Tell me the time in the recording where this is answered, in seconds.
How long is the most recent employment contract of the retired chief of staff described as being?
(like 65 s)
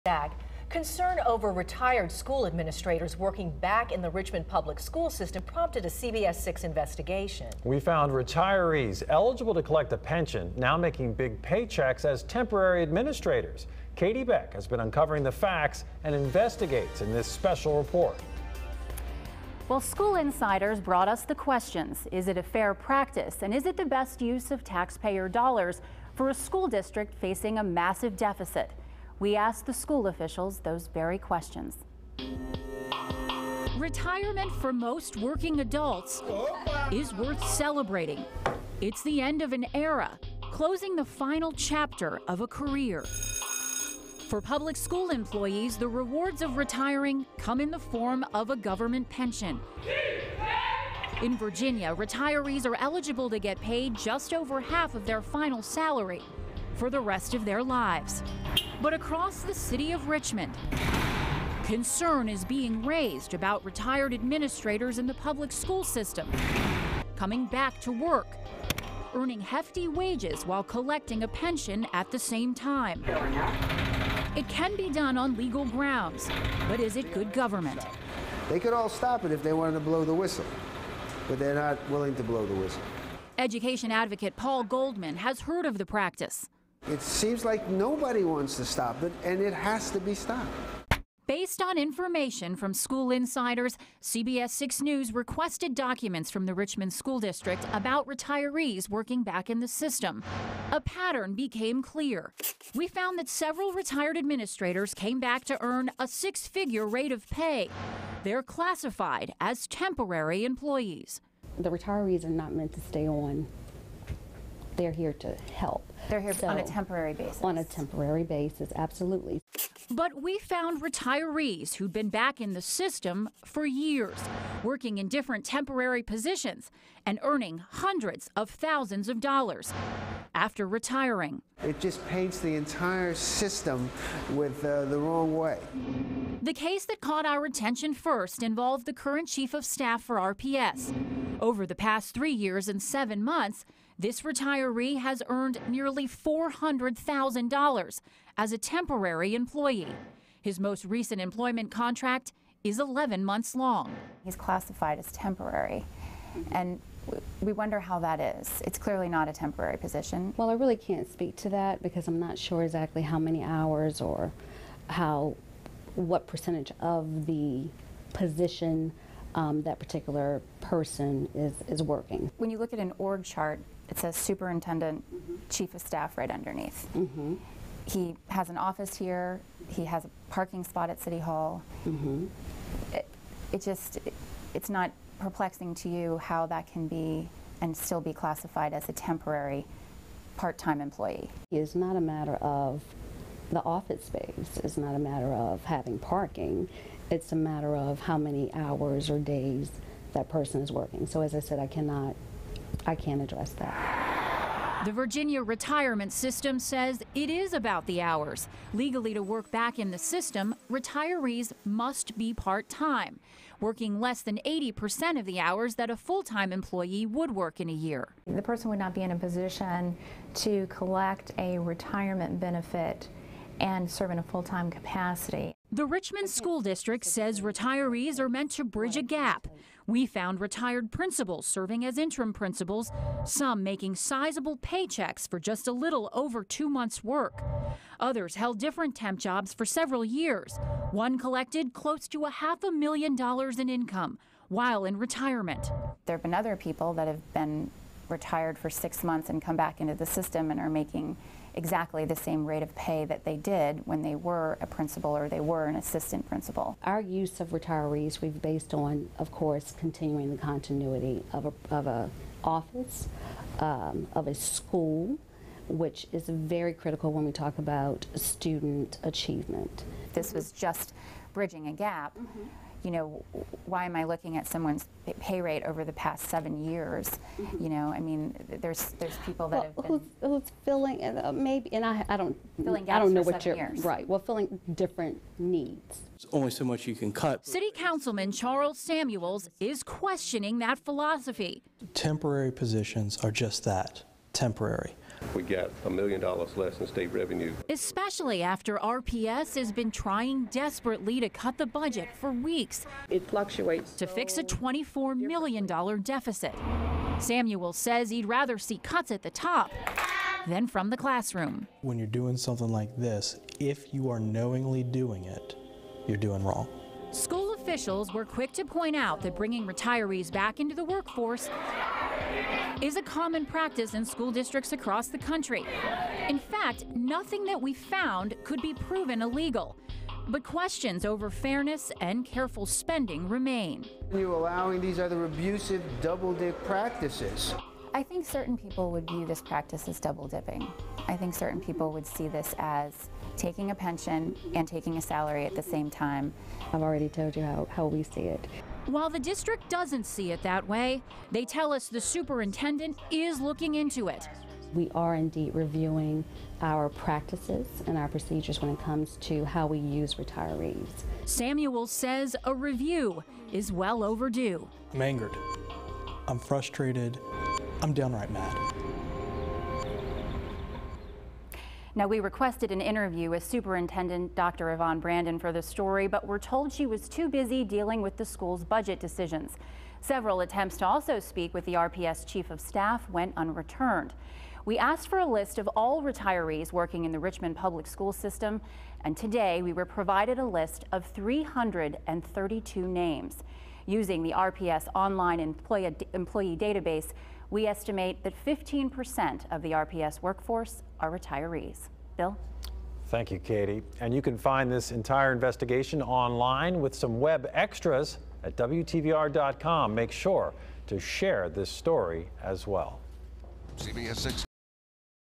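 152 s.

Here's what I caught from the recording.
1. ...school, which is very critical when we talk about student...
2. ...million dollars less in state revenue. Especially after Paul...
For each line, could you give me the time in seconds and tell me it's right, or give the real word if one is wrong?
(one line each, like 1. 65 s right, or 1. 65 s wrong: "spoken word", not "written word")
1. 264 s right
2. 295 s wrong: "RPS", not "Paul".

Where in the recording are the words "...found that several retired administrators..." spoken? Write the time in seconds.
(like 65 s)
102 s.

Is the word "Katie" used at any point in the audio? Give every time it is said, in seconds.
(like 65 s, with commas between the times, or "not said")
13 s, 403 s.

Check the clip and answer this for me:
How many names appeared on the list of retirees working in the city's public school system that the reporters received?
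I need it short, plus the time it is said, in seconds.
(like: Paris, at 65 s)
332, at 391 s.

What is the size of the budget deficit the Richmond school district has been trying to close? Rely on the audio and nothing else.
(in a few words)
$24 million.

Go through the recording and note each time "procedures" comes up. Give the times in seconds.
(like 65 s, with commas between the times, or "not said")
358 s.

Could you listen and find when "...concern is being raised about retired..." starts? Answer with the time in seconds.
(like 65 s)
61 s.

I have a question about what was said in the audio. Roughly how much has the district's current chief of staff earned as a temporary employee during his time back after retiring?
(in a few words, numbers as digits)
nearly $400,000.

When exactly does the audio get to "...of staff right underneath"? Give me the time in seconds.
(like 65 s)
175 s.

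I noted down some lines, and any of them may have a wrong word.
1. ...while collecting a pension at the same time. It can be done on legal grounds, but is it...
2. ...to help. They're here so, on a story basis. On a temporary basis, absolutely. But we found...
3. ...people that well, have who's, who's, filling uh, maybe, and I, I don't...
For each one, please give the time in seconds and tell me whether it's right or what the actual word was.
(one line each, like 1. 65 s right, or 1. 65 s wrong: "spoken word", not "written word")
1. 70 s right
2. 115 s wrong: "temporary", not "story"
3. 279 s right.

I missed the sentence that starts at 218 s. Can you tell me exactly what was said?
The person would not be in a position to collect a retirement benefit and serve in a full time capacity.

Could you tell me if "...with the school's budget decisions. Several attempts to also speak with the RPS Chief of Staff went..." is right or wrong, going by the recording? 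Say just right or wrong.
right.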